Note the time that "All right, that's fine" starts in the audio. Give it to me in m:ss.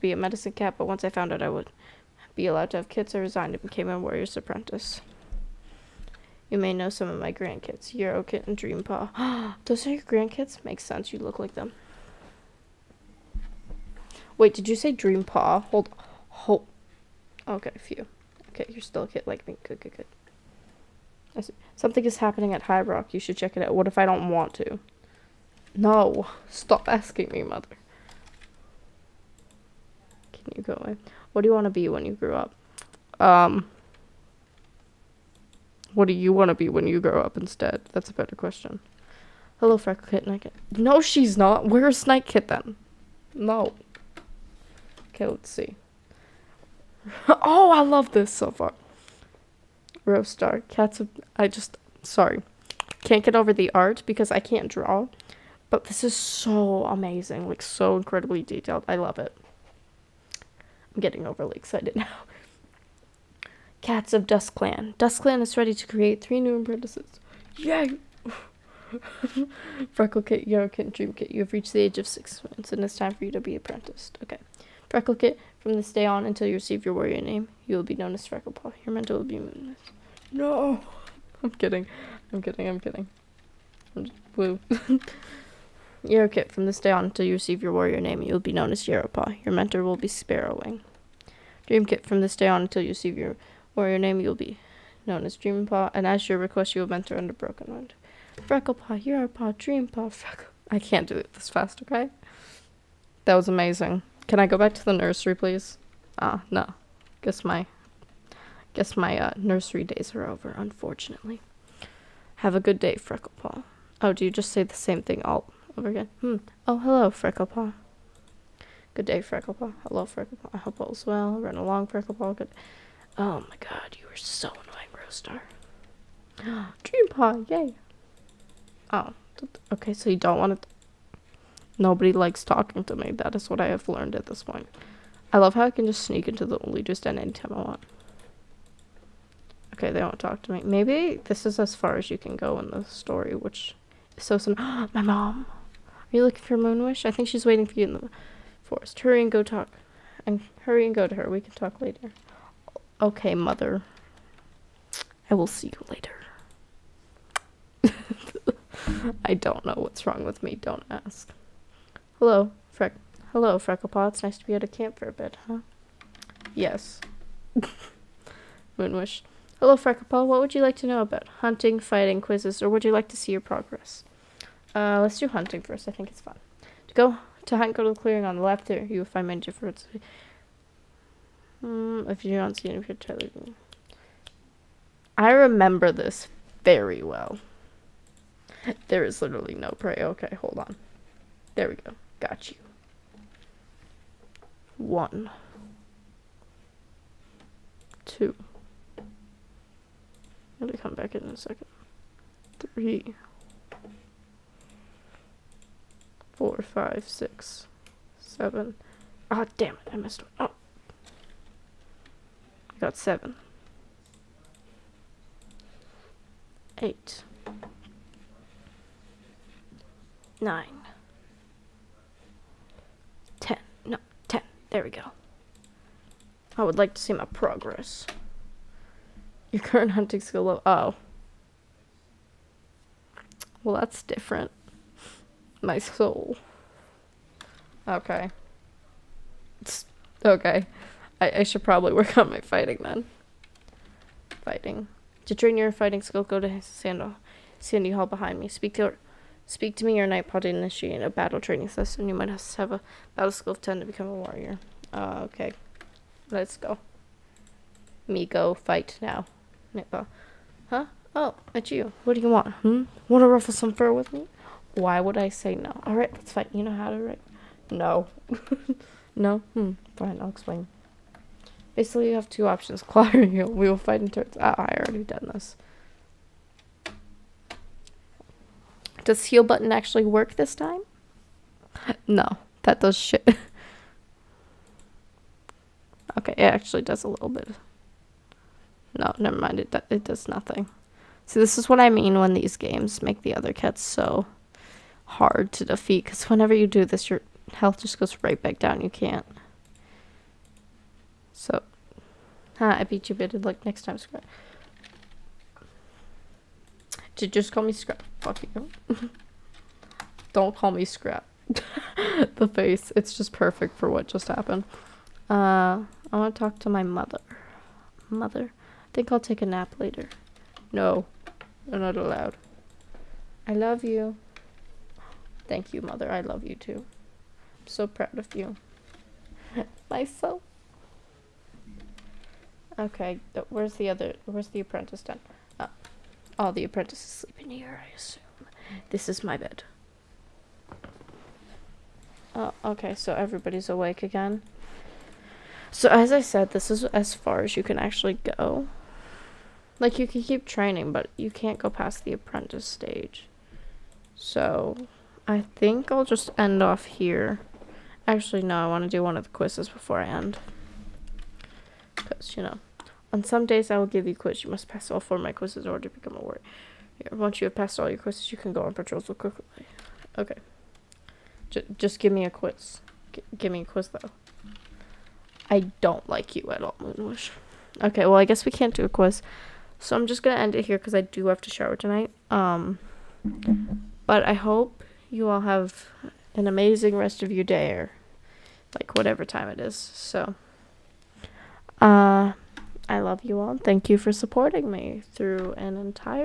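4:25.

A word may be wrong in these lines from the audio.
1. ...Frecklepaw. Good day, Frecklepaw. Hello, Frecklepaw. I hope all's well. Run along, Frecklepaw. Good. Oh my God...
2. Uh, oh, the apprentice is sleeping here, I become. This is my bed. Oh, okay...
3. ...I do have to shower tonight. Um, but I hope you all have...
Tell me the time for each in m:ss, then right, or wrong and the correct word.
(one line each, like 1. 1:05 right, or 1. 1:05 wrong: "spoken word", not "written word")
1. 1:57 right
2. 5:35 wrong: "assume", not "become"
3. 6:20 right.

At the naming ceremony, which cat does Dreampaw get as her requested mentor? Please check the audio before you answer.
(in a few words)
Broken Wind.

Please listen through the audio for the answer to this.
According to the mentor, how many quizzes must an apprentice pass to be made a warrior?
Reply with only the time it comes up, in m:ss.
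6:04.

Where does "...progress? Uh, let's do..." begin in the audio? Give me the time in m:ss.
2:53.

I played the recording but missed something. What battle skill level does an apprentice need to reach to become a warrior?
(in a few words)
10.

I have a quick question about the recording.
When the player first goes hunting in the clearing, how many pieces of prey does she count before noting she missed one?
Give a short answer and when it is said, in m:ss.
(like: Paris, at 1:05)
7, at 3:32.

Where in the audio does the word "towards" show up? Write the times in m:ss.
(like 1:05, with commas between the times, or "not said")
not said.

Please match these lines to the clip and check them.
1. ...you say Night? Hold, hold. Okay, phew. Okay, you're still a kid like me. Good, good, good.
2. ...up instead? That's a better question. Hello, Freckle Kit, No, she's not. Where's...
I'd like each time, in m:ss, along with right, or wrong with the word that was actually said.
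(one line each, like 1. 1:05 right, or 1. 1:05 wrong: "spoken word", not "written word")
1. 0:14 wrong: "Dreampaw", not "Night"
2. 0:37 right.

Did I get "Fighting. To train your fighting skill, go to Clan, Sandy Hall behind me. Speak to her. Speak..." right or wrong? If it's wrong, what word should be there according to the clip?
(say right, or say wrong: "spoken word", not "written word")
wrong: "Sandal", not "Clan".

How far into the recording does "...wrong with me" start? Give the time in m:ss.
2:40.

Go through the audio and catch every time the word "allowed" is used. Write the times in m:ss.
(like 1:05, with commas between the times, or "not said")
0:02, 5:21.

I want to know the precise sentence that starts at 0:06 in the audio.
You may know some of my grandkids, Yarrowkit and Dreampaw.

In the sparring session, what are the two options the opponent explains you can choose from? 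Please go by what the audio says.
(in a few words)
Claw or heal.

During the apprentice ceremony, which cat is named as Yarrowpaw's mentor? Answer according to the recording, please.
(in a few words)
Sparrowwing.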